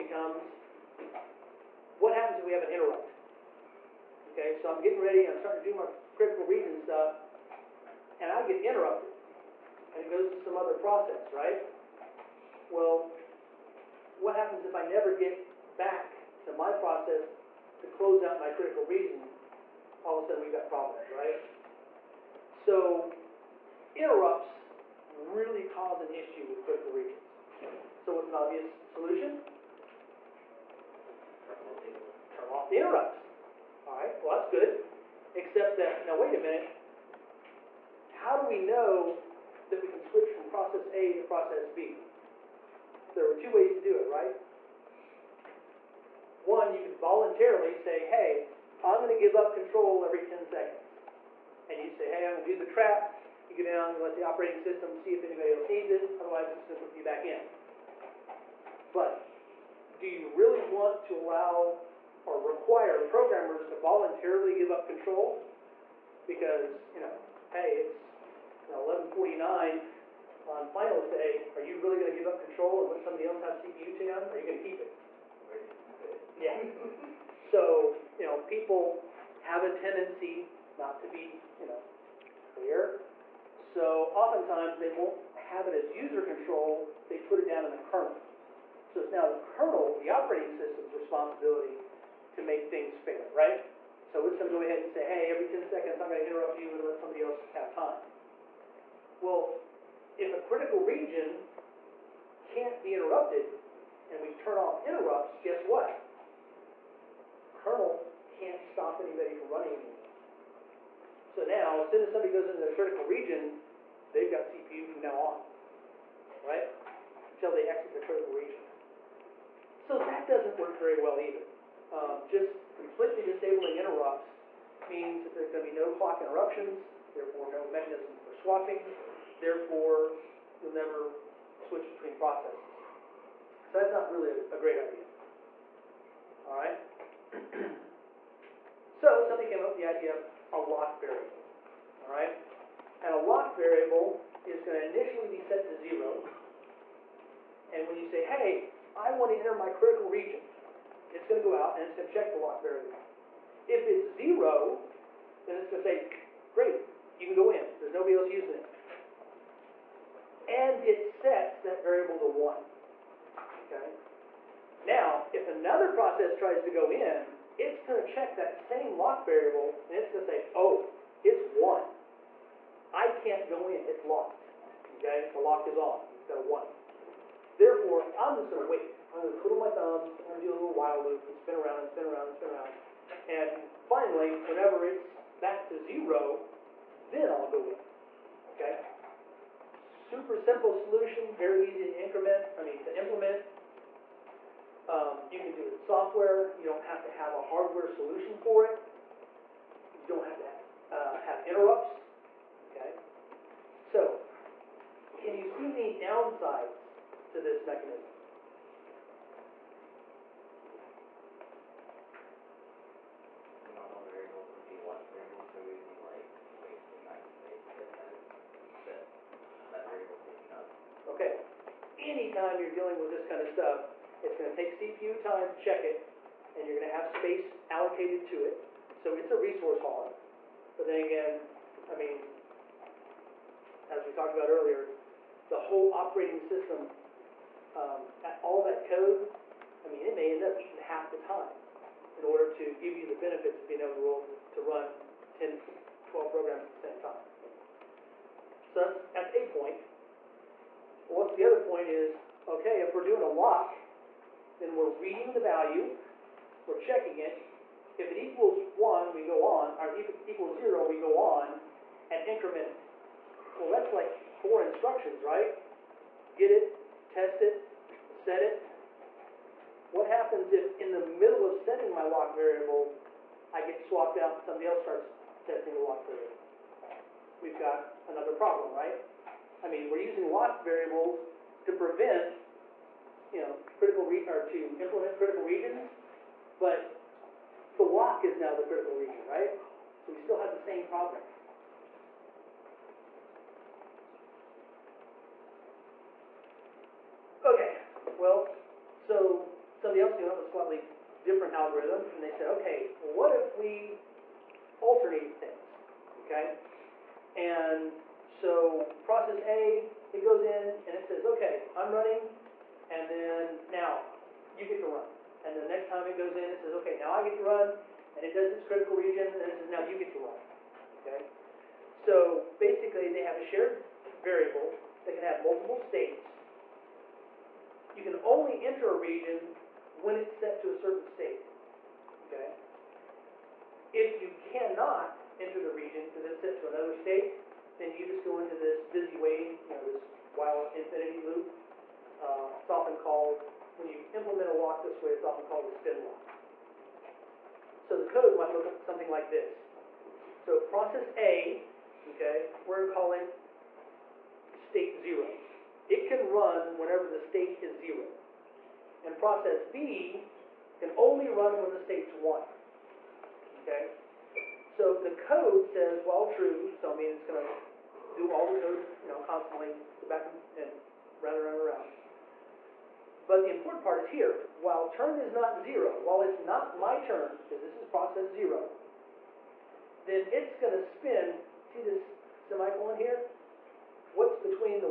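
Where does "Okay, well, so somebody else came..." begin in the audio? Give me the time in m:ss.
4:57.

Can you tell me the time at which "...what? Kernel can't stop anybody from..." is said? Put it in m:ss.
1:45.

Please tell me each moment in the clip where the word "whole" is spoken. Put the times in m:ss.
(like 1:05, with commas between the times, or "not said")
3:55.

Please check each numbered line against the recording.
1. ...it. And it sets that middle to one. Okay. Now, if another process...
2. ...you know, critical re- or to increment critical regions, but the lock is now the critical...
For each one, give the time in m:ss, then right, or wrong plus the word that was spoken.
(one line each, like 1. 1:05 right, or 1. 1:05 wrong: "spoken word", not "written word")
1. 2:38 wrong: "variable", not "middle"
2. 4:43 wrong: "implement", not "increment".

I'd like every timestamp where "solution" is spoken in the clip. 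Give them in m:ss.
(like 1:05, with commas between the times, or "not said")
0:28, 3:10, 3:17.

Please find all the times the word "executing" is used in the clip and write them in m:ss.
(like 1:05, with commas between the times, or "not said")
not said.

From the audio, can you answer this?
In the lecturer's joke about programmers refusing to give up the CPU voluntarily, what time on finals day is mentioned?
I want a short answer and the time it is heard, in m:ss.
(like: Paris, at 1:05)
11:49, at 1:08.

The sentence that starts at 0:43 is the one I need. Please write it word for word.
There are two ways to do it, right?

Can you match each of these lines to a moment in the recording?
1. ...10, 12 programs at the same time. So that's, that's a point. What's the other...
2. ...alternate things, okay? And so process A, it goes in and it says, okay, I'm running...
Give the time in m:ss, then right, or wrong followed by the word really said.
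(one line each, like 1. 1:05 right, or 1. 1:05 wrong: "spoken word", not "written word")
1. 4:05 right
2. 5:04 right.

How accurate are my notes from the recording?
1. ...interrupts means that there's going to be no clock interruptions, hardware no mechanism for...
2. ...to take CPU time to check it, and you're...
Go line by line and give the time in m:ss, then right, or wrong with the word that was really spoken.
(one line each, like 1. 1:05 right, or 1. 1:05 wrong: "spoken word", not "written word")
1. 2:03 wrong: "therefore", not "hardware"
2. 3:44 right.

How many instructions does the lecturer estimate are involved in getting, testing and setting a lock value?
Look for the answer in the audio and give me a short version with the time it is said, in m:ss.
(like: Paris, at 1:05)
4, at 4:24.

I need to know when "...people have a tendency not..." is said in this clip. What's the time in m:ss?
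1:18.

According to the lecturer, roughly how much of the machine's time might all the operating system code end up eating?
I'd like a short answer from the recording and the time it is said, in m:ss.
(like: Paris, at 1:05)
Half, at 4:00.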